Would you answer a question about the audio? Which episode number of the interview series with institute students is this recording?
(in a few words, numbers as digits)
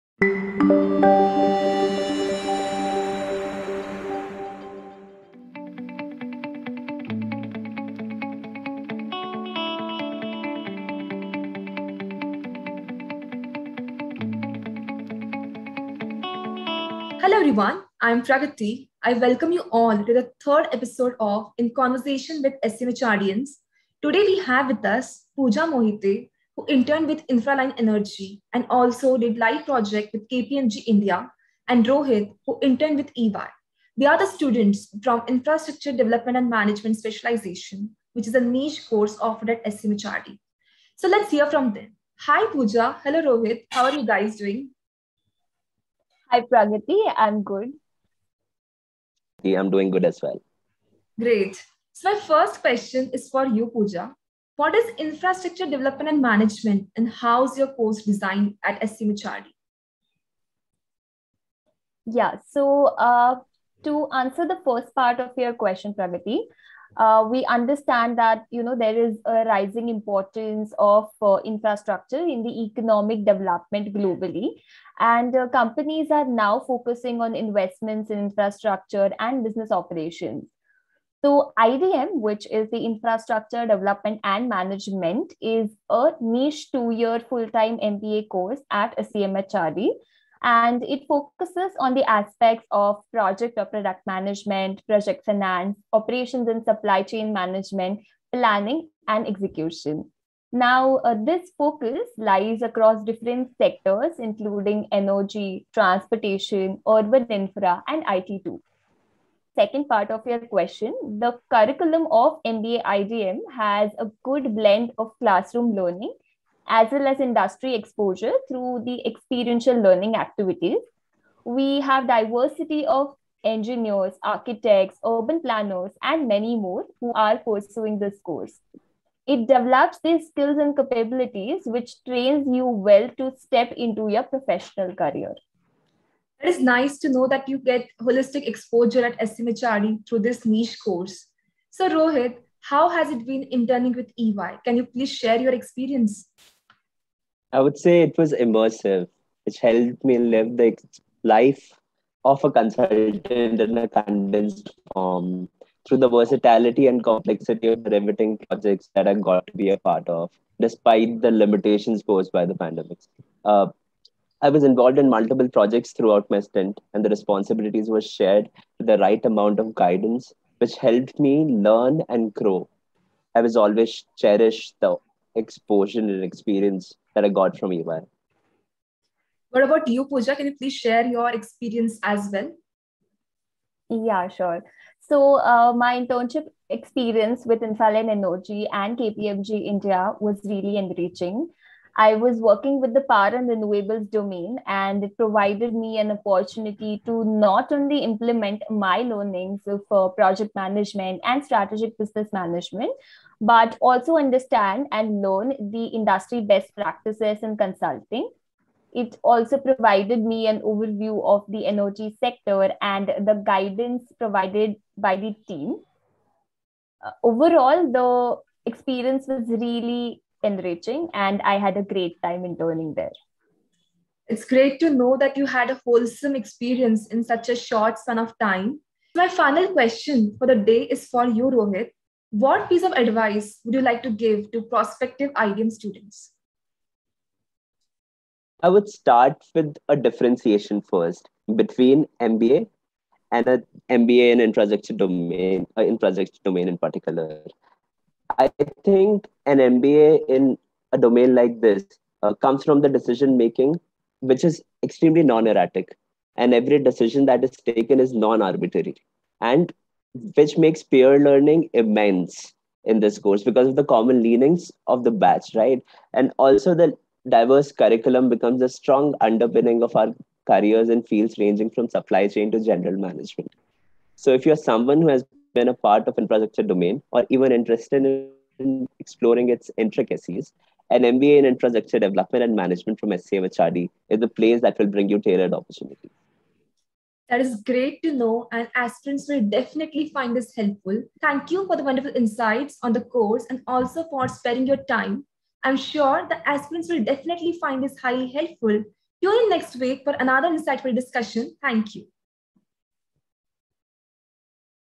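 third.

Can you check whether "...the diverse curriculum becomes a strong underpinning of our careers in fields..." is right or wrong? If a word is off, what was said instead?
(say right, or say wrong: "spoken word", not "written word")
right.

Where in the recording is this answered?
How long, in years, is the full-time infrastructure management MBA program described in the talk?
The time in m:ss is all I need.
1:26.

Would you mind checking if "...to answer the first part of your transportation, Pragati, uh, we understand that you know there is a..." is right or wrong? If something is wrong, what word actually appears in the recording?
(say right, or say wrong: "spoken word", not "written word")
wrong: "question", not "transportation".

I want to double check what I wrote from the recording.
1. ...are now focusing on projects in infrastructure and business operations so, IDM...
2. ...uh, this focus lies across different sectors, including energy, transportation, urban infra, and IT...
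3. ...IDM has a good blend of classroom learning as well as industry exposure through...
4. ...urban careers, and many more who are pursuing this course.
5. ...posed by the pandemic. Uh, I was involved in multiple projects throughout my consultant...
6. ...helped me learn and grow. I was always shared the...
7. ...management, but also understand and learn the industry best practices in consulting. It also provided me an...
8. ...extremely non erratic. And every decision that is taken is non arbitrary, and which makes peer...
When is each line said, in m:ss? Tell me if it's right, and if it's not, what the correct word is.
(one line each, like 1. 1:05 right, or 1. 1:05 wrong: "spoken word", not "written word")
1. 1:16 wrong: "investments", not "projects"
2. 1:41 right
3. 1:52 right
4. 2:05 wrong: "planners", not "careers"
5. 2:42 wrong: "stint", not "consultant"
6. 2:50 wrong: "cherished", not "shared"
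7. 3:22 right
8. 4:14 right.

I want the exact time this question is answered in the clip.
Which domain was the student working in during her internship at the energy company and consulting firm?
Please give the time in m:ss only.
3:13.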